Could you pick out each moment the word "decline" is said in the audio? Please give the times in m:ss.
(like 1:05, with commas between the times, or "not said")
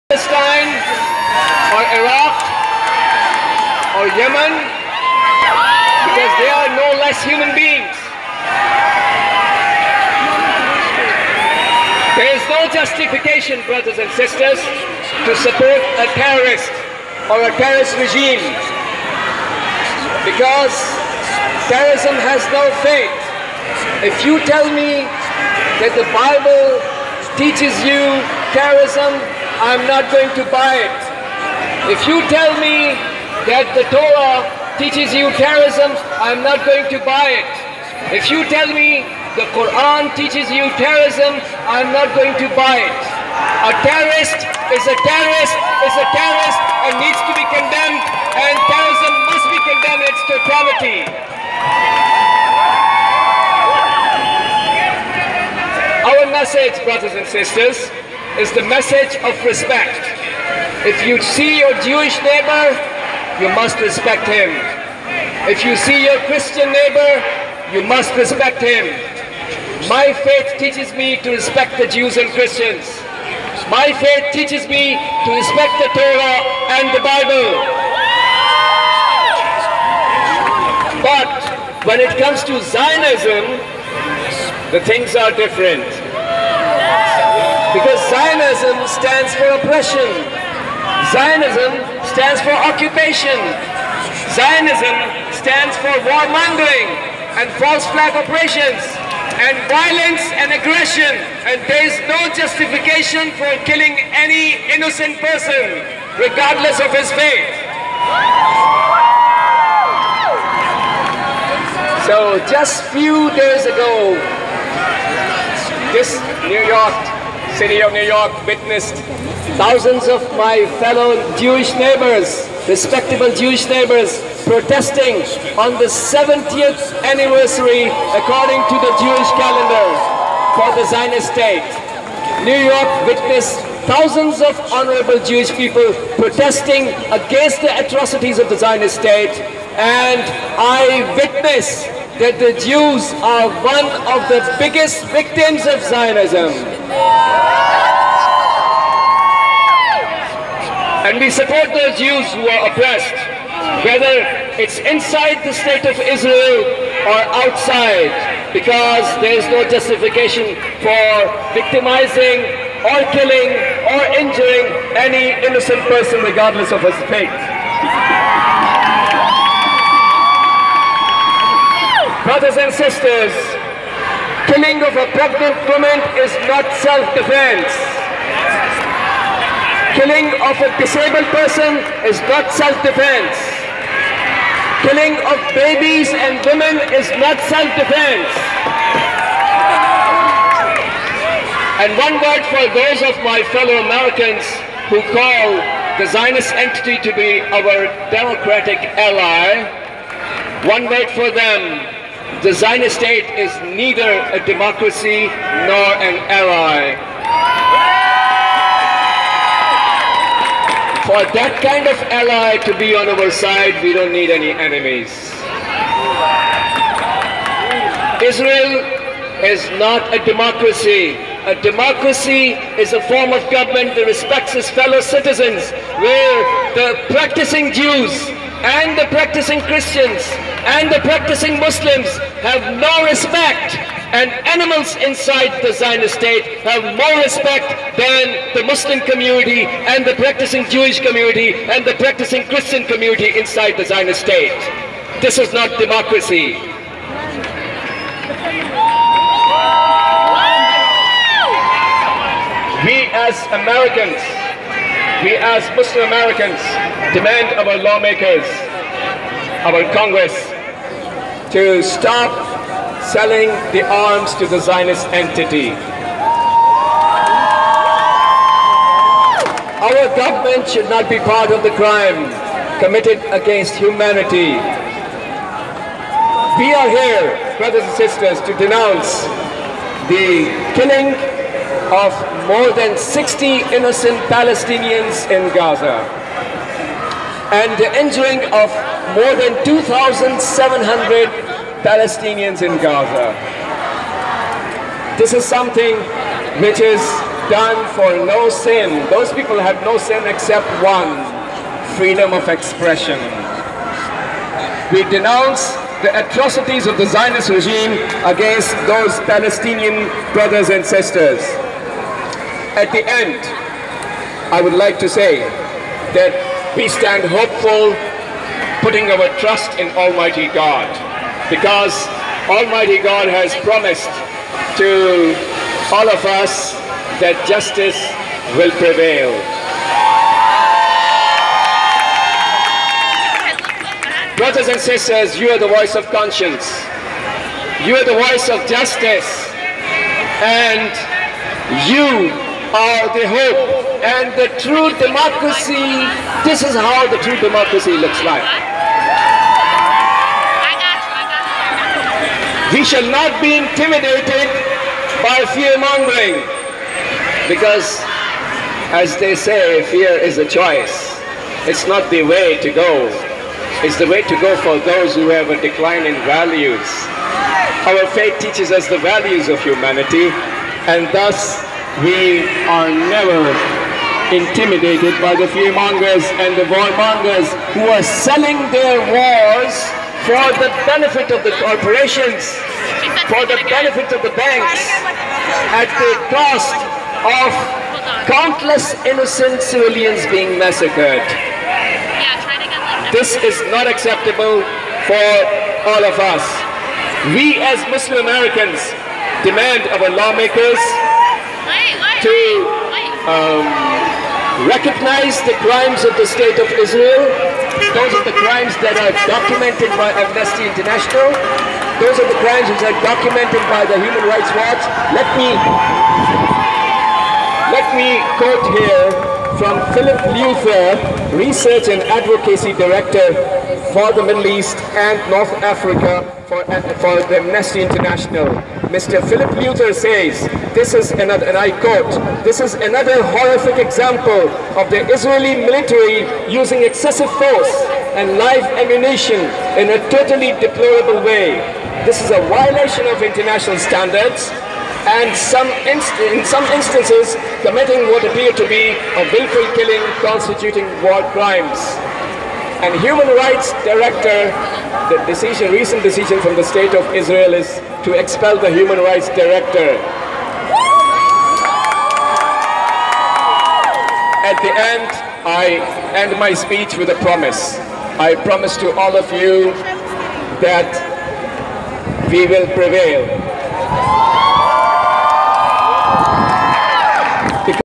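6:05.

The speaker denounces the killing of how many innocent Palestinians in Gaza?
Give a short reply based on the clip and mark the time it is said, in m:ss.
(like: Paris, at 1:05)
more than 60, at 4:42.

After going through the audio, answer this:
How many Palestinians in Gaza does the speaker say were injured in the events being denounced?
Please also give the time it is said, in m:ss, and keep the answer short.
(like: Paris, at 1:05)
more than 2,700, at 4:49.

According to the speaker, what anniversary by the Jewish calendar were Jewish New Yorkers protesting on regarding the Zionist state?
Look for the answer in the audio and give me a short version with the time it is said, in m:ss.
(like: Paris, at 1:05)
70th, at 2:05.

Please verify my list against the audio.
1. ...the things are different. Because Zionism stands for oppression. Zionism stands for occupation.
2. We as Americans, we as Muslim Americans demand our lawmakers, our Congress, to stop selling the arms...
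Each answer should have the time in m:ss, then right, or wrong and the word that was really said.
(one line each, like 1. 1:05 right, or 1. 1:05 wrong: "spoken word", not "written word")
1. 1:24 right
2. 4:12 right.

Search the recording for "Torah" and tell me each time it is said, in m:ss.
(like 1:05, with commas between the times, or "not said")
0:33, 1:15.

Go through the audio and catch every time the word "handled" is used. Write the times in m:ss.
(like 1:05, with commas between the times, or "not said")
not said.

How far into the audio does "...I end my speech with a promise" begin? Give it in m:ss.
7:45.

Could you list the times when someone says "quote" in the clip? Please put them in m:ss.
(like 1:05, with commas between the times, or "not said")
6:58, 7:11.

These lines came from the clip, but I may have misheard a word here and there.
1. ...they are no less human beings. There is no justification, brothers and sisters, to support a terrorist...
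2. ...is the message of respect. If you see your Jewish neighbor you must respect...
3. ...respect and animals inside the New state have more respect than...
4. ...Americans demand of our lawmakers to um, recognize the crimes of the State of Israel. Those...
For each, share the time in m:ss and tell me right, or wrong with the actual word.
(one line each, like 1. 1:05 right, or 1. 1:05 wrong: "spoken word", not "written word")
1. 0:06 right
2. 0:58 right
3. 3:53 wrong: "Zionist", not "New"
4. 6:38 right.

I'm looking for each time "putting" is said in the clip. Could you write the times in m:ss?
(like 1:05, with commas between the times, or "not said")
5:18.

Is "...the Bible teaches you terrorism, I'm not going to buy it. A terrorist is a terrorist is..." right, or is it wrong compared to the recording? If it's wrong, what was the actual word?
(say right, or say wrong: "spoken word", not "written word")
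wrong: "Quran", not "Bible".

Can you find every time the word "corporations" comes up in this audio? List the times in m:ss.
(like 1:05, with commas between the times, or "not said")
6:21.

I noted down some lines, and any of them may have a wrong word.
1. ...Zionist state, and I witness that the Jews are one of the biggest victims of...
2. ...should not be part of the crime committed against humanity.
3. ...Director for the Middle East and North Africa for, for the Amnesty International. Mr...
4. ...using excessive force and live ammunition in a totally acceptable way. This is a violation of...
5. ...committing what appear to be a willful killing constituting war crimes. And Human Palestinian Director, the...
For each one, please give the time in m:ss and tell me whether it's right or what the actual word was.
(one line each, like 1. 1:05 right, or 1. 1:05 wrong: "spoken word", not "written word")
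1. 2:18 right
2. 4:30 right
3. 7:02 right
4. 7:16 wrong: "deplorable", not "acceptable"
5. 7:27 wrong: "Rights", not "Palestinian".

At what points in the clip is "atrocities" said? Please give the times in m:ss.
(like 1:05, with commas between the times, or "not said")
2:17, 5:06.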